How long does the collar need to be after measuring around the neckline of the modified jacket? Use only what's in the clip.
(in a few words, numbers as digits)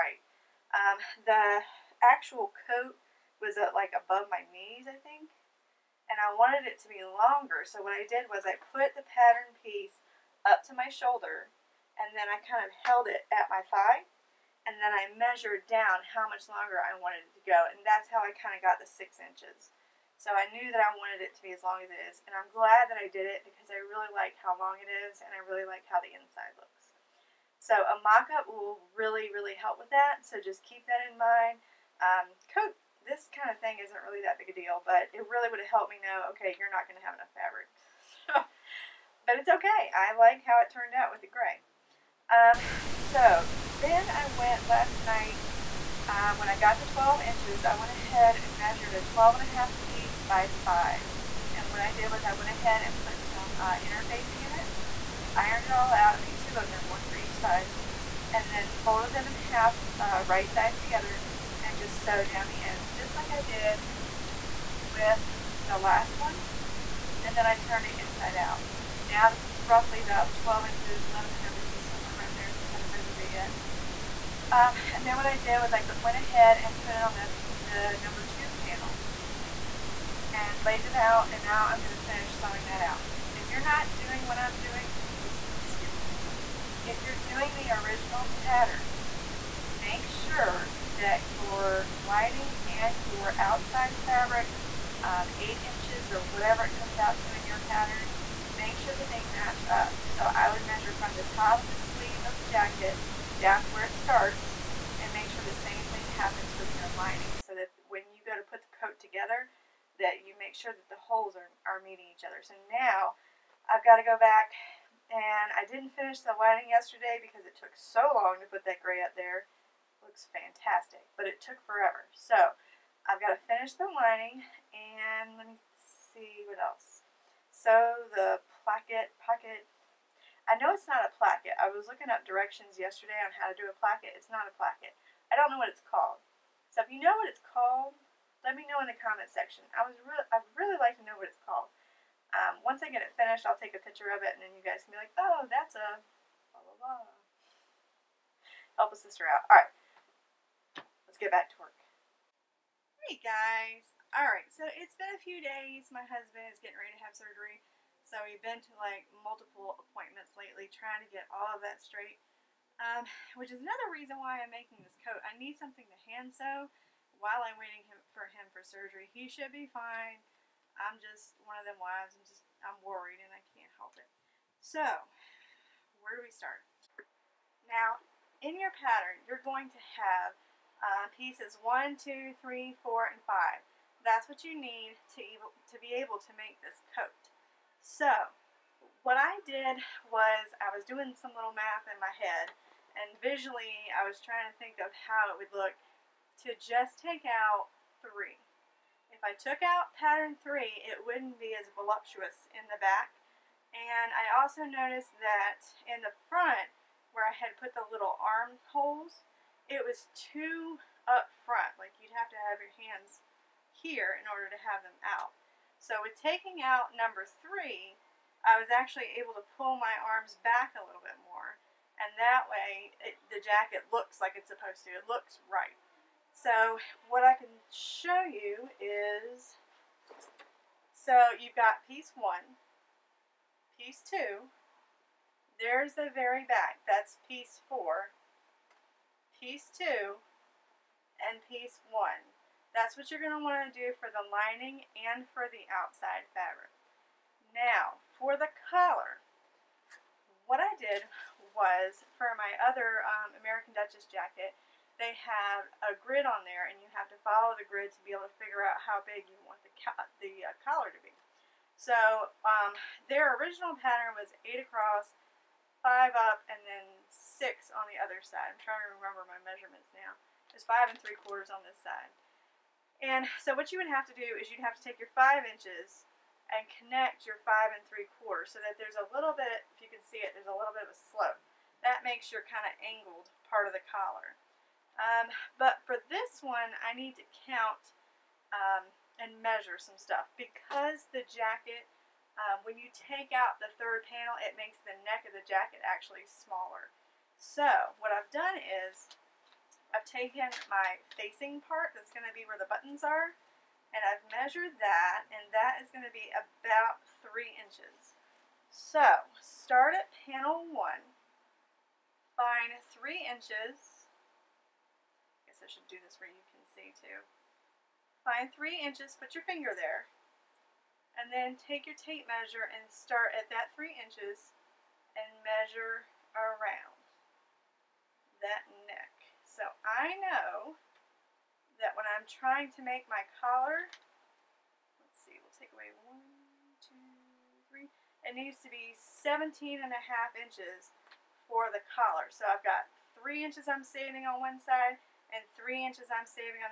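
17.5 inches.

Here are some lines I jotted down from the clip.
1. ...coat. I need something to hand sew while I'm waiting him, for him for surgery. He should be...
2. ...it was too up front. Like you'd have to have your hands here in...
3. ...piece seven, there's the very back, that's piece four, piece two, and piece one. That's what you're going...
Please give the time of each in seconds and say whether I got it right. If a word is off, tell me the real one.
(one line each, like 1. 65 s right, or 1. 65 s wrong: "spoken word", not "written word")
1. 165 s right
2. 209 s right
3. 233 s wrong: "two", not "seven".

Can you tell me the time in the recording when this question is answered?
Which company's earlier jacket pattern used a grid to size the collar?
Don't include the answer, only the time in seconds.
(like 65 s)
253 s.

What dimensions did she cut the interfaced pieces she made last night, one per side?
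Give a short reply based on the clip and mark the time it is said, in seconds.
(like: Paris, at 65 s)
12.5 by 5, at 49 s.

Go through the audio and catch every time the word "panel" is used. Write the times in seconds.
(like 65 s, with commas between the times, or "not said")
78 s, 294 s, 310 s.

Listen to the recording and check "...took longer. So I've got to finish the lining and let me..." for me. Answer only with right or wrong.
wrong.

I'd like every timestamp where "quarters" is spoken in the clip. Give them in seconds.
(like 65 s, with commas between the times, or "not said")
271 s, 278 s.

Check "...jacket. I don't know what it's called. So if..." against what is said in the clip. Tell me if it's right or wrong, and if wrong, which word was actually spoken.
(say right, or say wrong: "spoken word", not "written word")
wrong: "placket", not "jacket".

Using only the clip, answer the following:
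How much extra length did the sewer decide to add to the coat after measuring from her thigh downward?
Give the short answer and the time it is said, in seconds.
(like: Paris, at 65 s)
6 inches, at 18 s.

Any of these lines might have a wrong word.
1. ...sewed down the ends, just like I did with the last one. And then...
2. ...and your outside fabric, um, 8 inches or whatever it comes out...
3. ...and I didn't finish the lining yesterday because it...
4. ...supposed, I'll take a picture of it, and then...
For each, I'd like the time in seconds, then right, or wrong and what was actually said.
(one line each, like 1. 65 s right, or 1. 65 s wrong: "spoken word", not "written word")
1. 62 s right
2. 92 s right
3. 115 s right
4. 143 s wrong: "finished", not "supposed".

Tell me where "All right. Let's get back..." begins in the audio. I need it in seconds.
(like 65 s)
149 s.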